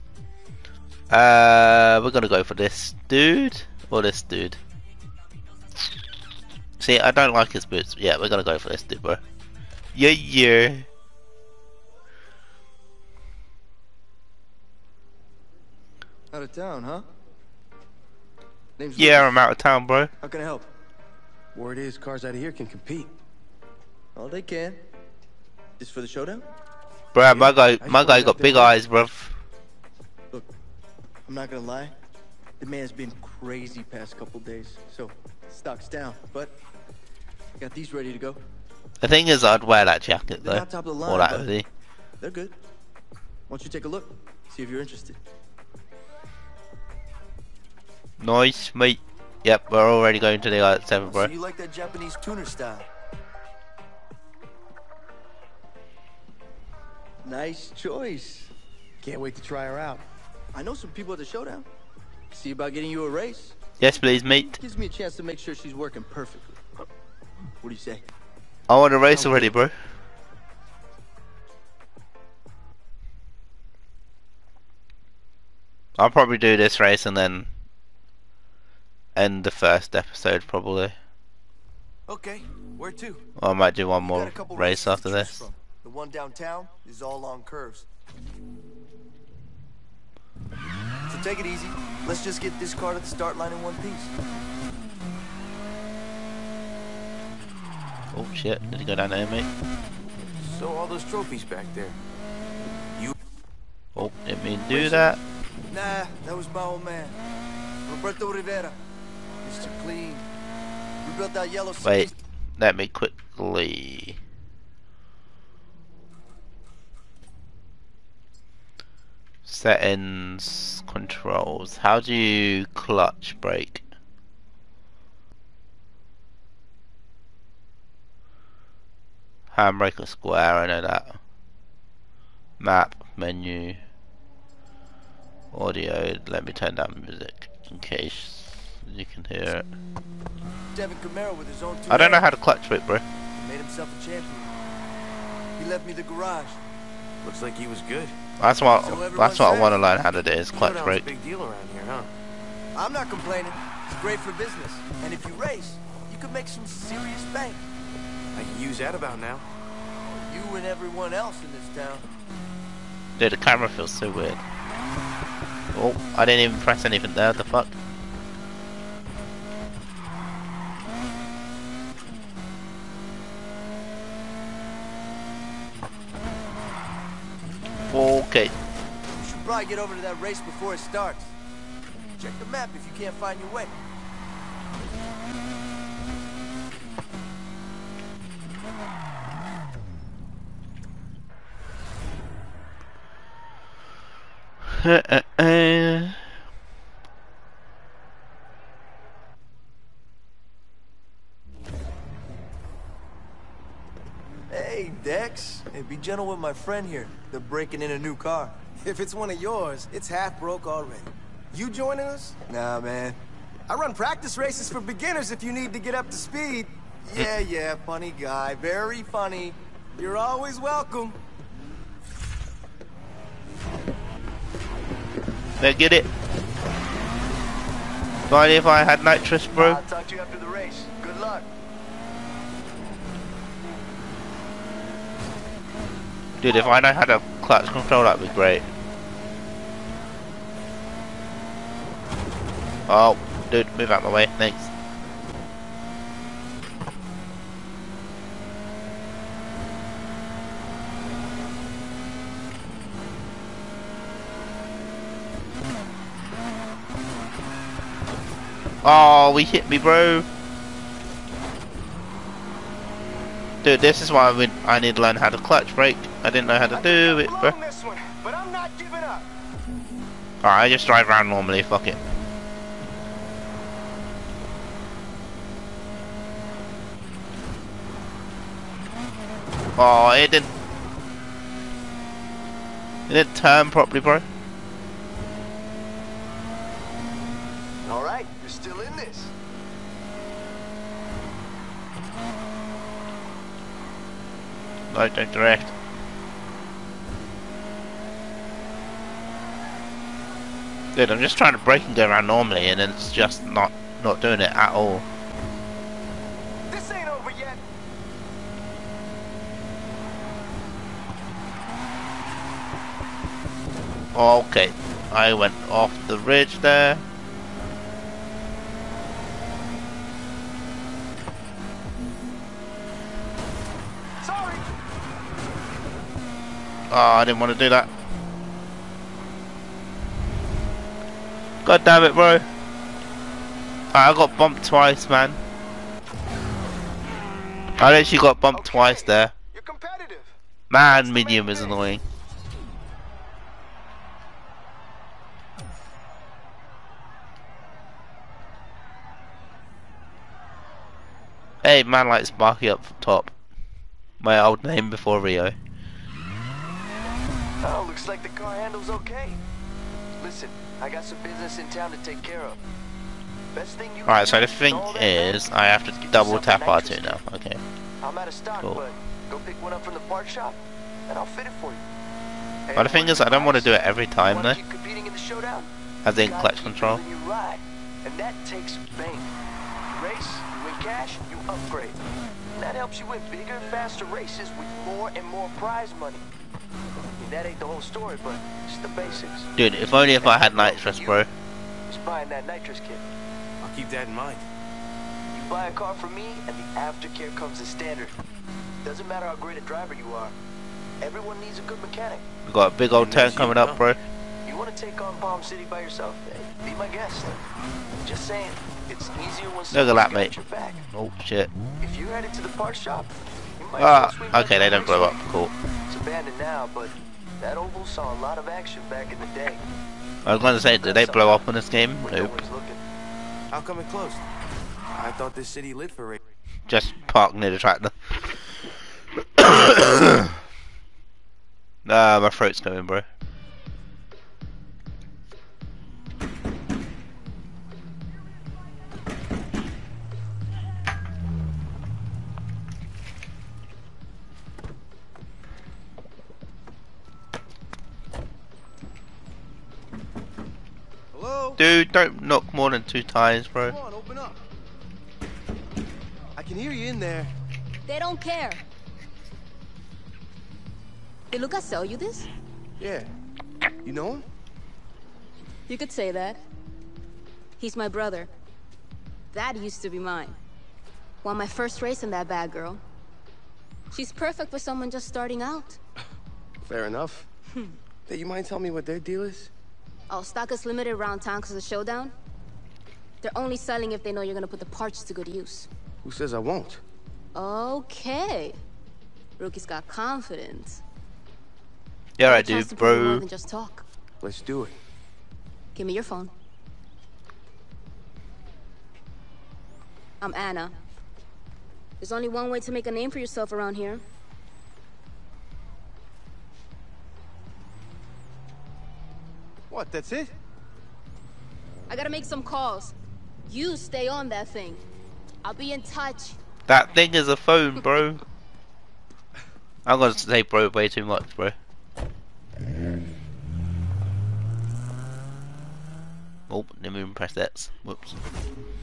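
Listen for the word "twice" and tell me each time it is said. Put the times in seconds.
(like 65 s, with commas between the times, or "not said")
334 s, 338 s.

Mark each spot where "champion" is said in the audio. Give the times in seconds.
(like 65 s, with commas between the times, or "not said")
144 s.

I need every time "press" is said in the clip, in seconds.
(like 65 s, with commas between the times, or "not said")
166 s, 527 s.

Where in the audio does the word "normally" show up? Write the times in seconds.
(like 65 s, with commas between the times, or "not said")
271 s, 302 s.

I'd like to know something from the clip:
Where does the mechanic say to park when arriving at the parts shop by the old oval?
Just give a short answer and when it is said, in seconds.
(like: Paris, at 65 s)
near the tractor, at 427 s.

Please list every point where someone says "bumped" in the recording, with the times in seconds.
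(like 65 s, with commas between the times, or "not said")
334 s, 338 s.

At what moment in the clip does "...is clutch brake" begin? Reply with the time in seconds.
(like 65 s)
150 s.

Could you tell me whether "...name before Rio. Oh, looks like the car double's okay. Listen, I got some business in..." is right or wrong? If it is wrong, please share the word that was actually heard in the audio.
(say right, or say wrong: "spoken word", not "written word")
wrong: "handle", not "double".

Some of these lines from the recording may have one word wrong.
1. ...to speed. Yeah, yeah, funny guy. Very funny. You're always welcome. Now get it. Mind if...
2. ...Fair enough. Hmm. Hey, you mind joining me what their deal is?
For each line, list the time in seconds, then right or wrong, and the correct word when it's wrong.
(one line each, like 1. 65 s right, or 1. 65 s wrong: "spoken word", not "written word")
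1. 216 s right
2. 476 s wrong: "telling", not "joining".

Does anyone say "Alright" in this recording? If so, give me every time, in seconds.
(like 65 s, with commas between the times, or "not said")
270 s, 287 s.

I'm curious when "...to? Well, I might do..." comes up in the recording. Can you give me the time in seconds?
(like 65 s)
82 s.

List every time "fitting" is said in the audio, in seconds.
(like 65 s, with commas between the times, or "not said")
not said.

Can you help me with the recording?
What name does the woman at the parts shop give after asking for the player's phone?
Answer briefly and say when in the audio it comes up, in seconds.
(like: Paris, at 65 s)
Anna, at 500 s.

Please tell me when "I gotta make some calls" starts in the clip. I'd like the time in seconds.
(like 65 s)
511 s.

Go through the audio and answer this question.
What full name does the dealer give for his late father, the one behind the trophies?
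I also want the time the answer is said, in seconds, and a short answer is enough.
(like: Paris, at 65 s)
Roberto Rivera, at 107 s.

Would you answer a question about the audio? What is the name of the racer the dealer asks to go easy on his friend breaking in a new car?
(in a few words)
Dex.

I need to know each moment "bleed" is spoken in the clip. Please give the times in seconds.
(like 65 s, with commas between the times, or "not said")
not said.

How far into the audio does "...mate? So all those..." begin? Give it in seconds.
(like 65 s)
99 s.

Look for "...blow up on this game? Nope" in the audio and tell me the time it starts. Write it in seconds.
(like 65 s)
421 s.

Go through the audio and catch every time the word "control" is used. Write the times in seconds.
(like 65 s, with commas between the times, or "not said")
120 s, 237 s, 376 s.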